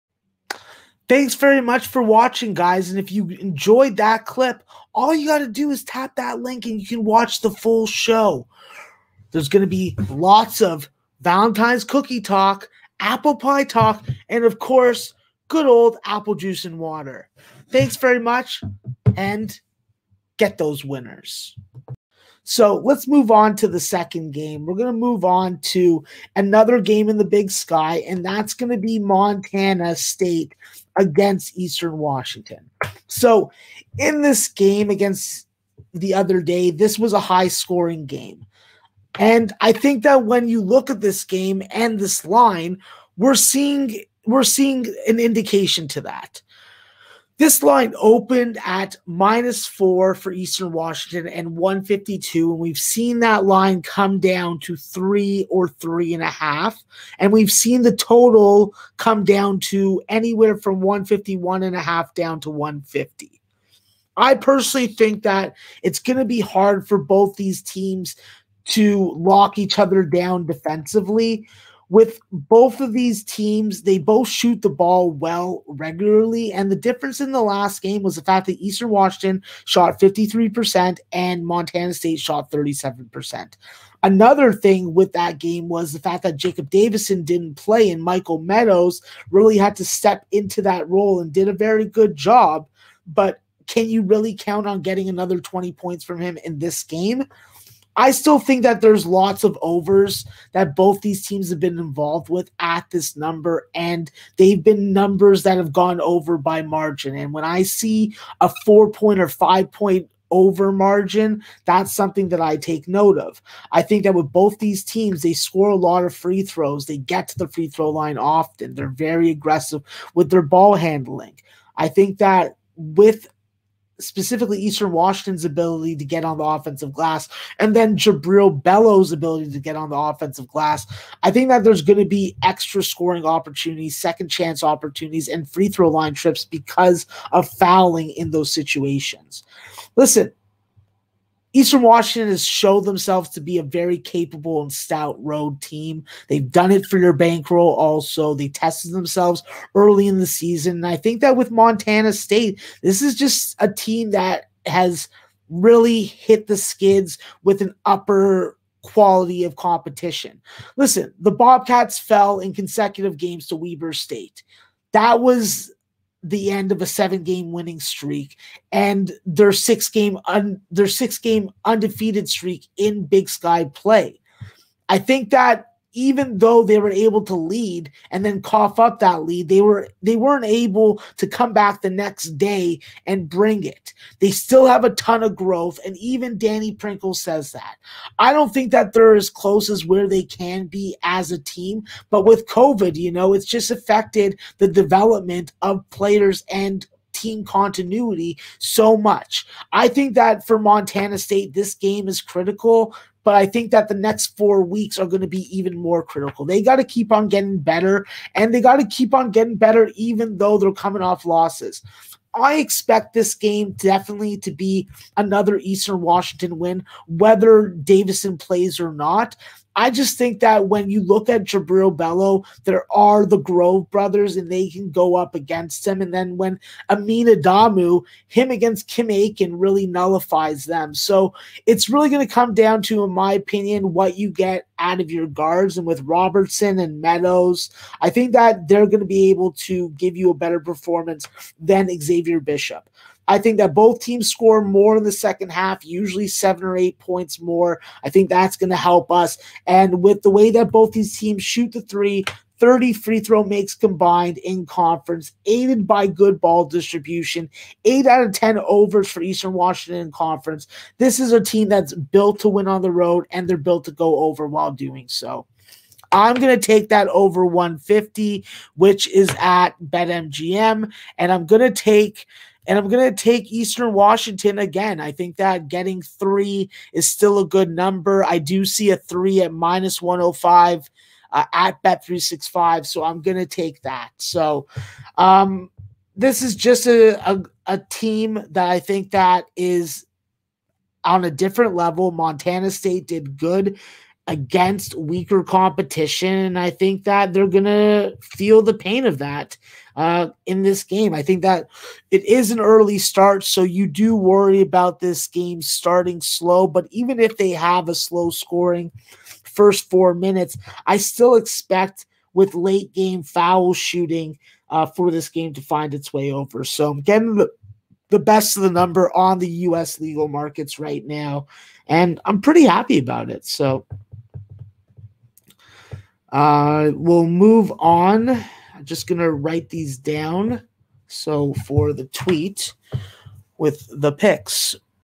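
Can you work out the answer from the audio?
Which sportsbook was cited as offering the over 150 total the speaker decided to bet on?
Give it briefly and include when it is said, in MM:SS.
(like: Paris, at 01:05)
BetMGM, at 04:29.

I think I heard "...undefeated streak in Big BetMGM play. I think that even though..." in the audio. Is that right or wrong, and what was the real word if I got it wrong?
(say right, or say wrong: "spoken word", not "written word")
wrong: "Sky", not "BetMGM".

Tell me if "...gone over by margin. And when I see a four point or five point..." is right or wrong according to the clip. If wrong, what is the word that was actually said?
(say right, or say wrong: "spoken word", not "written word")
right.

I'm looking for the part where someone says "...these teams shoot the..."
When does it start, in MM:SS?
04:10.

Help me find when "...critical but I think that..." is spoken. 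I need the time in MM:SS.
03:22.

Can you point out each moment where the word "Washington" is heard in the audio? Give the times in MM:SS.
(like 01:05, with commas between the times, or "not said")
00:31, 00:50, 01:18, 02:04, 02:21, 03:36, 04:19, 04:33.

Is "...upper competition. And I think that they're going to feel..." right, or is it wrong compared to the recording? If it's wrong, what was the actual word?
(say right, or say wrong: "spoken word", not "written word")
wrong: "weaker", not "upper".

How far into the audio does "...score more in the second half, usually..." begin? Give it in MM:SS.
04:04.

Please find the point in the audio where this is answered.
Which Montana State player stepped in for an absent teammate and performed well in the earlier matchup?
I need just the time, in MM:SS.
01:28.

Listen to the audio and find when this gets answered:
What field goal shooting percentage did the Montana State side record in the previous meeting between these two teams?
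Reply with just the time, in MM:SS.
01:22.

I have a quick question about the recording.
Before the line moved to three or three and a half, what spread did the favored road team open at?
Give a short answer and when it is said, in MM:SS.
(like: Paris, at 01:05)
-4, at 00:49.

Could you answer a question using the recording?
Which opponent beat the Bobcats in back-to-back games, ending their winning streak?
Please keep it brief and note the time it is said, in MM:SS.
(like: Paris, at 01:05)
Weber State, at 02:43.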